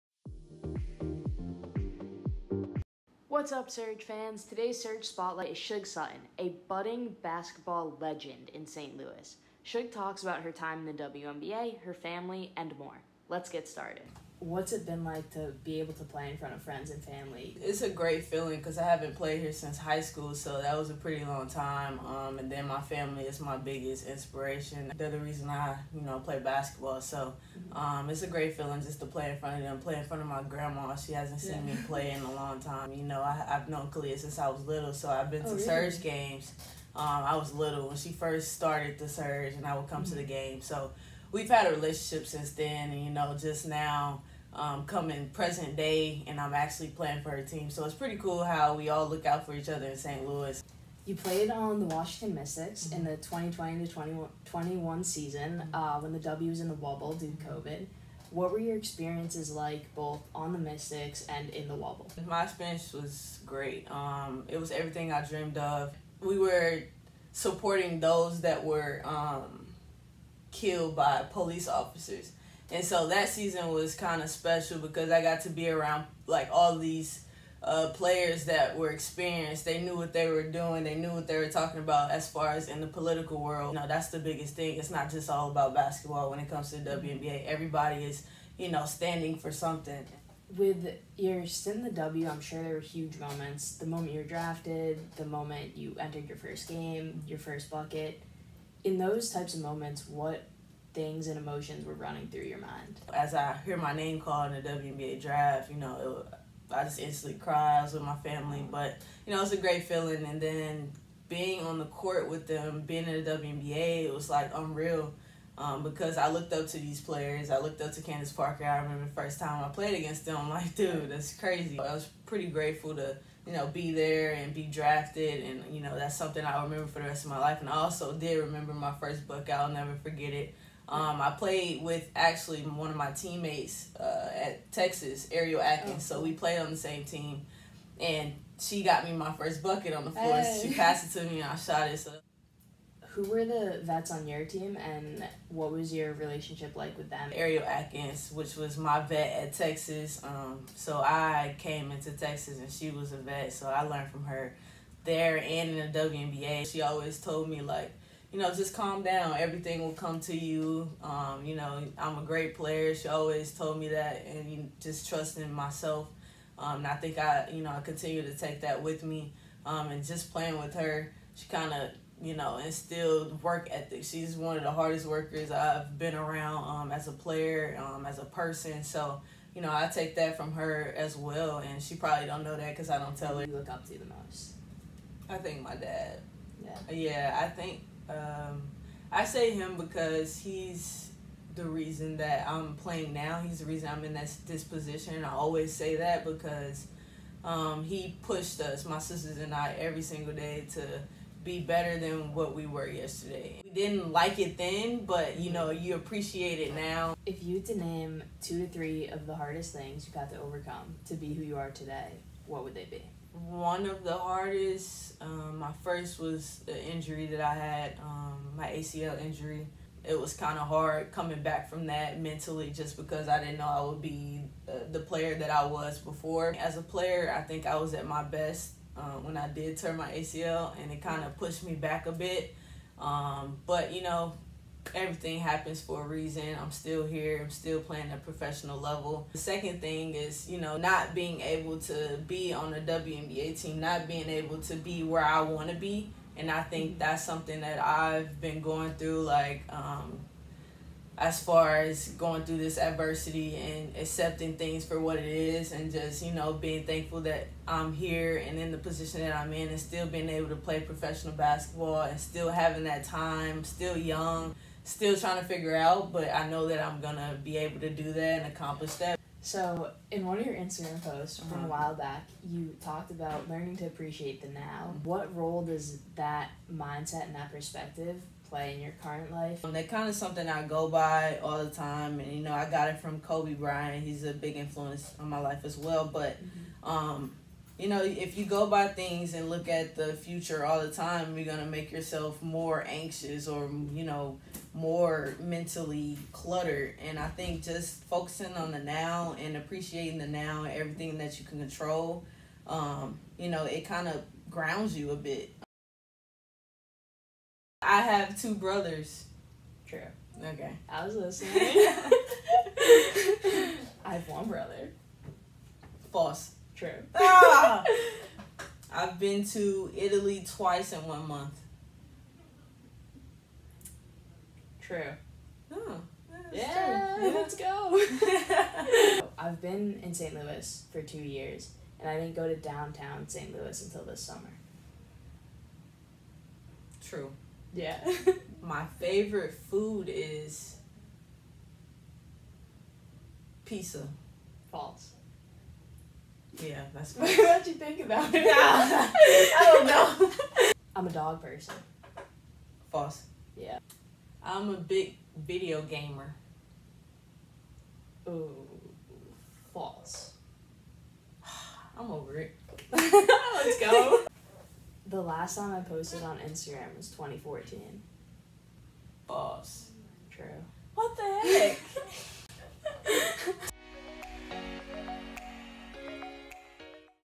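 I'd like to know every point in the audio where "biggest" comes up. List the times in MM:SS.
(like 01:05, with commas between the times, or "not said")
00:23, 01:24.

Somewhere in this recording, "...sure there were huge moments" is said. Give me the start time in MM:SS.
01:32.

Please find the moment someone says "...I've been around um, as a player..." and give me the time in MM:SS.
02:55.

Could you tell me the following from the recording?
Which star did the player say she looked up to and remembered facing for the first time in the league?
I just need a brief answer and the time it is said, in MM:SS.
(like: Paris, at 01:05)
Candace Parker, at 01:58.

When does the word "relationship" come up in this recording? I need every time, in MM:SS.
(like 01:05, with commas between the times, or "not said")
00:41, 02:26.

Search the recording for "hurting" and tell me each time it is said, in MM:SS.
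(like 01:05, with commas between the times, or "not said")
not said.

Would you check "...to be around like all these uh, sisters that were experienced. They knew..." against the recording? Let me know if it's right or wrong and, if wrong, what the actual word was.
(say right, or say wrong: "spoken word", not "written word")
wrong: "players", not "sisters".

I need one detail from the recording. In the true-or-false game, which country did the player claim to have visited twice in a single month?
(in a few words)
Italy.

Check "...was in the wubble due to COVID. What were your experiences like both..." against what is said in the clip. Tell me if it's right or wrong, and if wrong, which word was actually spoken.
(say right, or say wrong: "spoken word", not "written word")
right.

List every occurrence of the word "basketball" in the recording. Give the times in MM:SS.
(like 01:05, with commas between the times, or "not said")
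00:07, 00:26, 01:25, 04:21.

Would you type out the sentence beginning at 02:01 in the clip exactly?
I was pretty grateful to, you know, be there and be drafted.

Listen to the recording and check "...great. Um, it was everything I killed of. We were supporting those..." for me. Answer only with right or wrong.
wrong.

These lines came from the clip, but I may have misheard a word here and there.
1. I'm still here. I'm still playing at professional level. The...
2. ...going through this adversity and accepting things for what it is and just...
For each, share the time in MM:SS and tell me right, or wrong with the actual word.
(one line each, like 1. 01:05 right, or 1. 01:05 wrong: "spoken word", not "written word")
1. 03:56 right
2. 04:12 right.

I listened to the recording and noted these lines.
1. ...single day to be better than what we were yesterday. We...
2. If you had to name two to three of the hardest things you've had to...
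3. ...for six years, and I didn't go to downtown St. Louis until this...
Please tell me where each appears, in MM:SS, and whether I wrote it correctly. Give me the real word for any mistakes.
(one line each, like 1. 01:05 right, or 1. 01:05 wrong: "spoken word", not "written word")
1. 03:20 right
2. 03:27 right
3. 05:30 wrong: "two", not "six".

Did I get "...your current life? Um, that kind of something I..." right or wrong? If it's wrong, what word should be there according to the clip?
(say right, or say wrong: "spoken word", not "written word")
right.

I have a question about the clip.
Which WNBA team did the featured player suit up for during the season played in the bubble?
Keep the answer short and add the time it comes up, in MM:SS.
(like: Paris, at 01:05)
Washington Mystics, at 00:51.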